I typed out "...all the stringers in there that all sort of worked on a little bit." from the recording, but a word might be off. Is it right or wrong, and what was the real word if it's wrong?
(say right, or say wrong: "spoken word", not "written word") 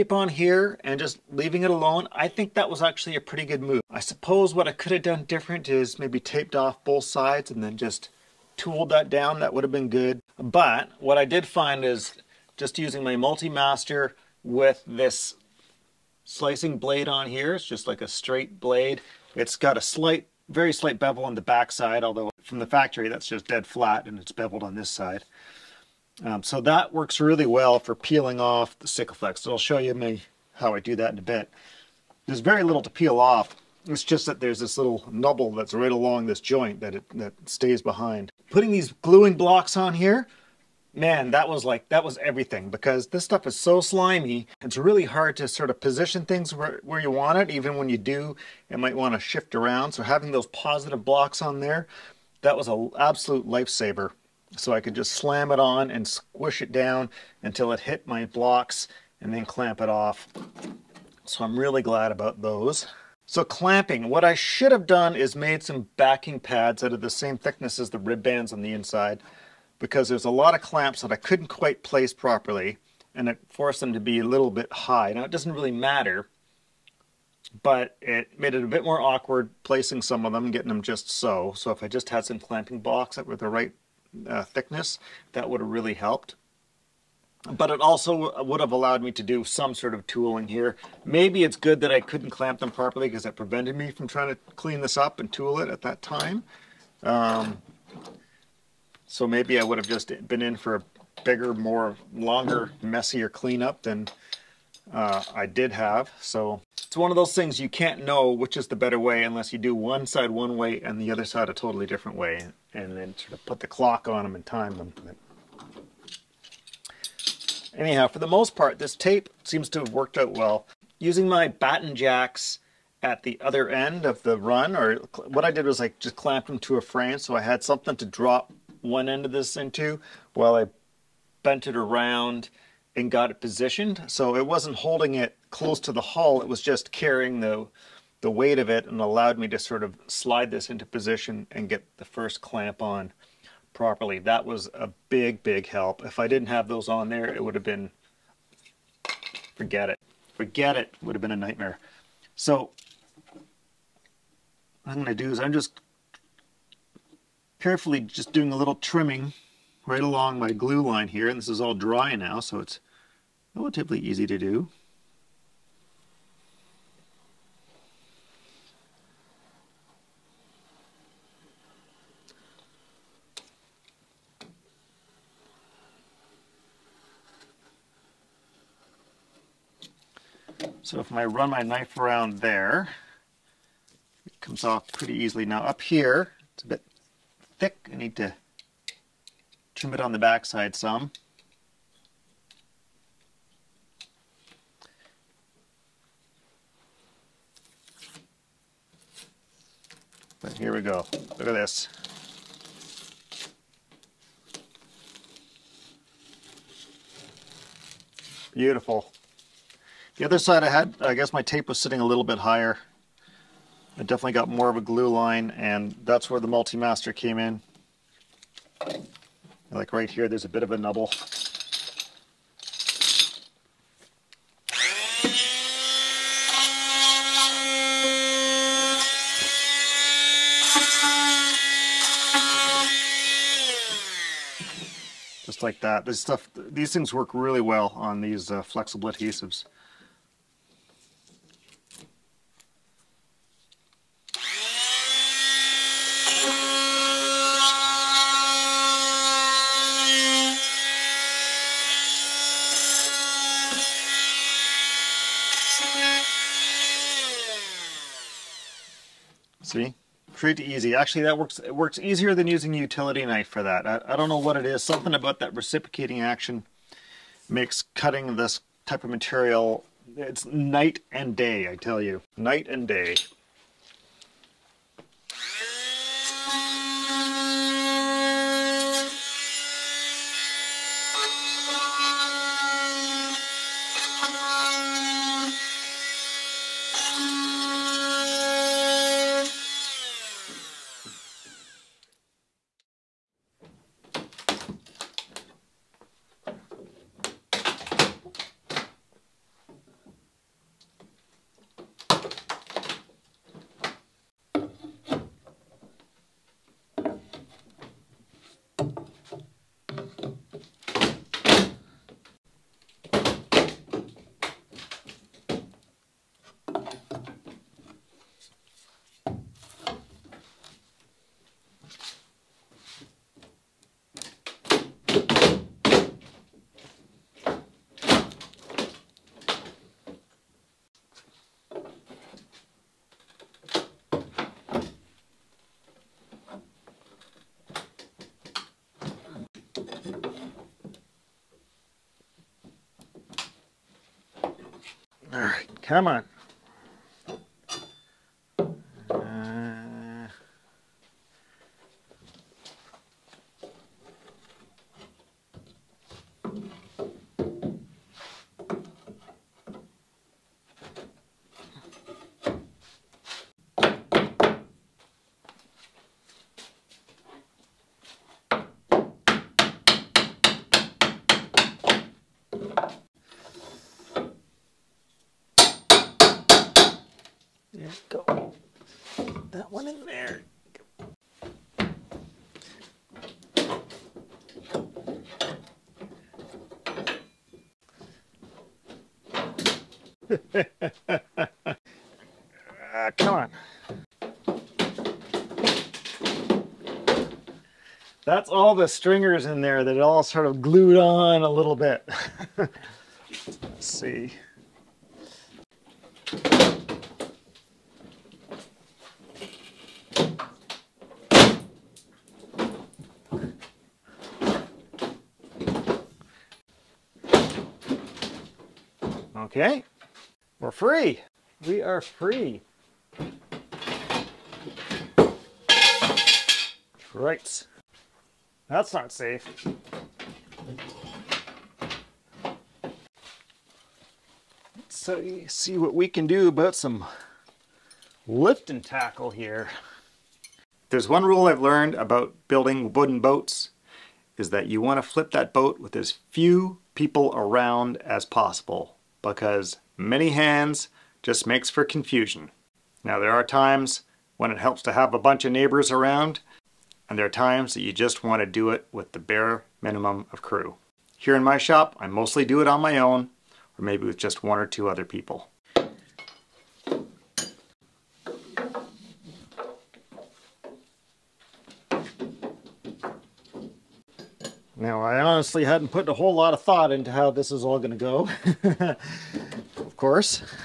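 wrong: "glued", not "worked".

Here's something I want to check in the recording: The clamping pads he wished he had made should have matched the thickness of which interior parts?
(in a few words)
rib bands.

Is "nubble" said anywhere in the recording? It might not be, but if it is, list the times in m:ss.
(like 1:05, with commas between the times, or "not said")
0:35, 3:40.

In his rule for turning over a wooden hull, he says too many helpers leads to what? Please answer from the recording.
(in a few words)
confusion.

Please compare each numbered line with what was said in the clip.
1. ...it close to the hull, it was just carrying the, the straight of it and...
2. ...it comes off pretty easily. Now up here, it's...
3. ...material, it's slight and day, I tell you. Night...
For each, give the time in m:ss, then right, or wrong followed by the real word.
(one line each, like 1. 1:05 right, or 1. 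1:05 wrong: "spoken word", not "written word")
1. 2:15 wrong: "weight", not "straight"
2. 3:04 right
3. 4:29 wrong: "night", not "slight".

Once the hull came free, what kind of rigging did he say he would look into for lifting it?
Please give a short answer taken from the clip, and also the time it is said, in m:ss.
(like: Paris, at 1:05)
lift and tackle, at 7:18.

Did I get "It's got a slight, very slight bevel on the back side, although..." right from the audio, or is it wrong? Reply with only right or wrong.
right.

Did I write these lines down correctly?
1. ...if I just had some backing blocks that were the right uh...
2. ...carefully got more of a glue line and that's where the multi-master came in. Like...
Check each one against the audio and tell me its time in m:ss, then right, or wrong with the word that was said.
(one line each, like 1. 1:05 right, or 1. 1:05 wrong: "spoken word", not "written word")
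1. 1:21 wrong: "clamping", not "backing"
2. 3:34 wrong: "definitely", not "carefully".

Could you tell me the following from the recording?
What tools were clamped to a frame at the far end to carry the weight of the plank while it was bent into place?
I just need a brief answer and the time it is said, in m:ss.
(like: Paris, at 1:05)
batten jacks, at 2:01.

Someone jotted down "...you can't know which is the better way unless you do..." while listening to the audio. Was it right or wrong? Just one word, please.
right.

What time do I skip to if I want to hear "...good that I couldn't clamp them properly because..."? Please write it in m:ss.
1:31.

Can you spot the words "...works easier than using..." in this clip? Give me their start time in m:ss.
4:21.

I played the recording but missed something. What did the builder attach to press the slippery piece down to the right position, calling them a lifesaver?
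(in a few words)
gluing blocks.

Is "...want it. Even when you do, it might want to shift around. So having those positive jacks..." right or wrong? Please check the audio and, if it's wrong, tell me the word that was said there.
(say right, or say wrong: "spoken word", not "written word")
wrong: "blocks", not "jacks".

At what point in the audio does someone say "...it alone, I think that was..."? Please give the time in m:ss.
0:01.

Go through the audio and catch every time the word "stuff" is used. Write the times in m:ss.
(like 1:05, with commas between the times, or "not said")
0:43, 3:56.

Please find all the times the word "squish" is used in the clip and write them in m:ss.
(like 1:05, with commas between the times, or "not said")
0:56.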